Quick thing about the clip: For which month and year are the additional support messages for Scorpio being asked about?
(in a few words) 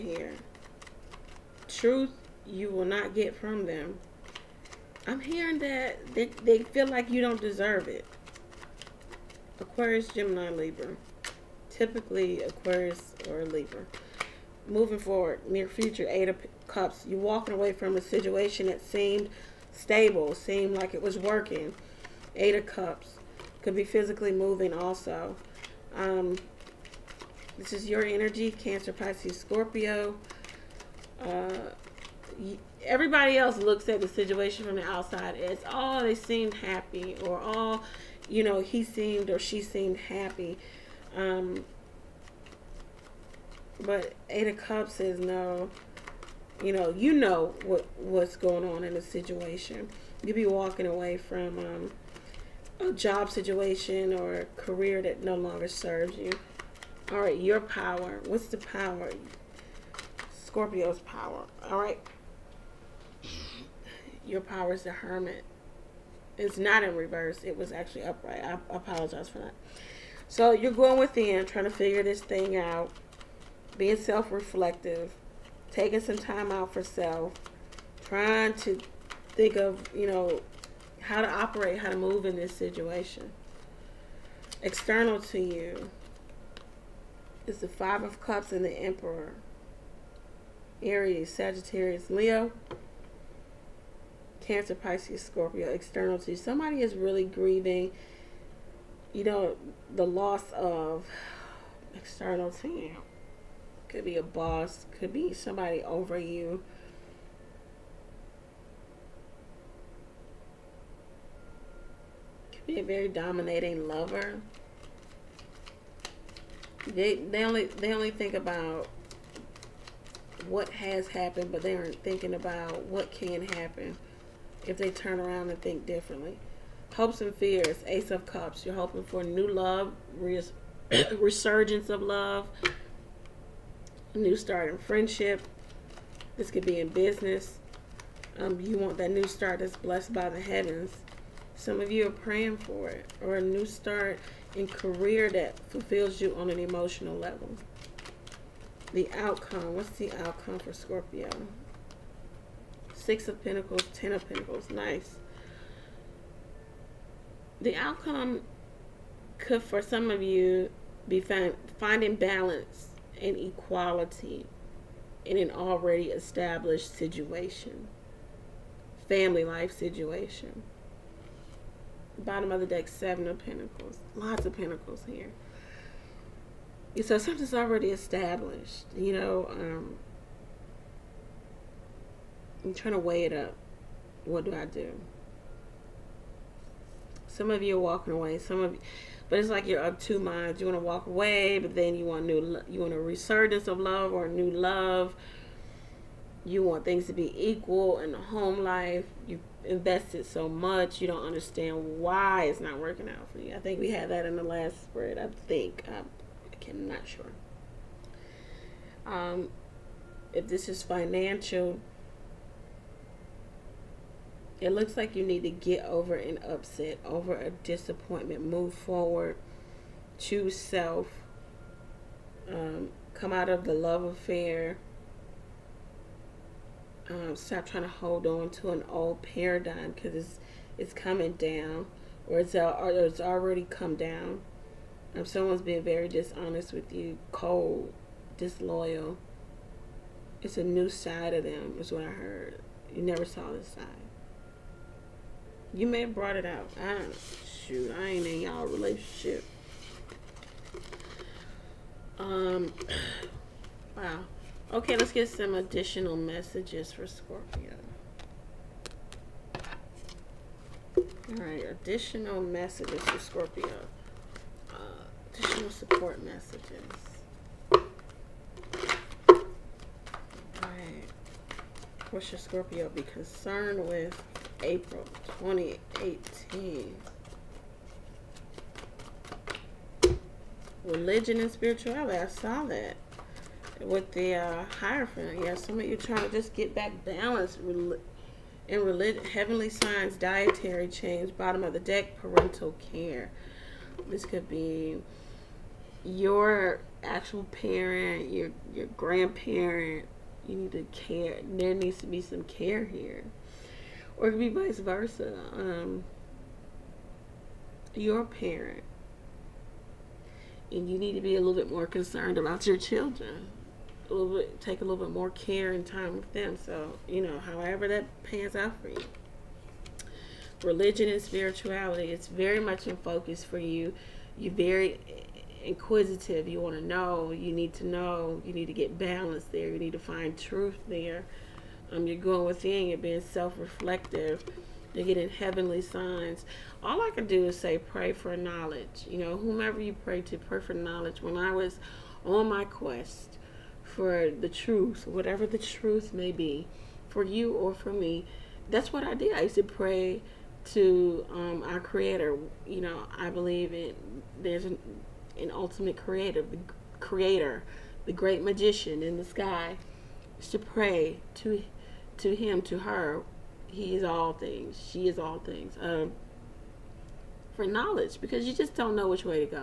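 April 2018.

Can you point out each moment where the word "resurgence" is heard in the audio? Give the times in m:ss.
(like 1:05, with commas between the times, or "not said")
2:11, 3:12.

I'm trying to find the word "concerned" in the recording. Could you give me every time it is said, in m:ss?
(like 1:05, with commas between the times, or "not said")
4:33, 5:11.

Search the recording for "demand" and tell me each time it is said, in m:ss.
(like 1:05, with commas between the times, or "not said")
not said.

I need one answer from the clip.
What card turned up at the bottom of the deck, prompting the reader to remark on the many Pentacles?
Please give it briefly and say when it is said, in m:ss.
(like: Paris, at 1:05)
Seven of Pentacles, at 2:52.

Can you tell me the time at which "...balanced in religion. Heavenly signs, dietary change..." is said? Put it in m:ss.
4:47.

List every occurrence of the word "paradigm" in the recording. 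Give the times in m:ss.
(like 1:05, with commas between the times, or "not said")
3:49.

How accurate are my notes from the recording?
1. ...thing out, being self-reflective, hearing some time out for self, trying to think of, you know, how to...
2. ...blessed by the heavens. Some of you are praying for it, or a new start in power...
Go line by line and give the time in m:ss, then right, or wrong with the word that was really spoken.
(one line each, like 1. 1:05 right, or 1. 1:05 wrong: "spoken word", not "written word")
1. 1:12 wrong: "taking", not "hearing"
2. 2:19 wrong: "career", not "power".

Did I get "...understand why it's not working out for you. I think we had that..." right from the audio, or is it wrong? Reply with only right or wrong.
right.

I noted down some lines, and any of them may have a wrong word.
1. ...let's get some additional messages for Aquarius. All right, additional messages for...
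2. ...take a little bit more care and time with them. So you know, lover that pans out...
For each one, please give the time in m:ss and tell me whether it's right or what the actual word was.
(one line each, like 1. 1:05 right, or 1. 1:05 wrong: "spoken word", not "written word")
1. 4:14 wrong: "Scorpio", not "Aquarius"
2. 5:14 wrong: "however", not "lover".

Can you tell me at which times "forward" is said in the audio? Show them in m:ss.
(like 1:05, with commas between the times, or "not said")
0:14, 3:38.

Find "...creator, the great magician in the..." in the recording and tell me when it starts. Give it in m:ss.
5:56.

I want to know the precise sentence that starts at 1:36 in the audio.
Somebody is really grieving, you know, the loss of external to you.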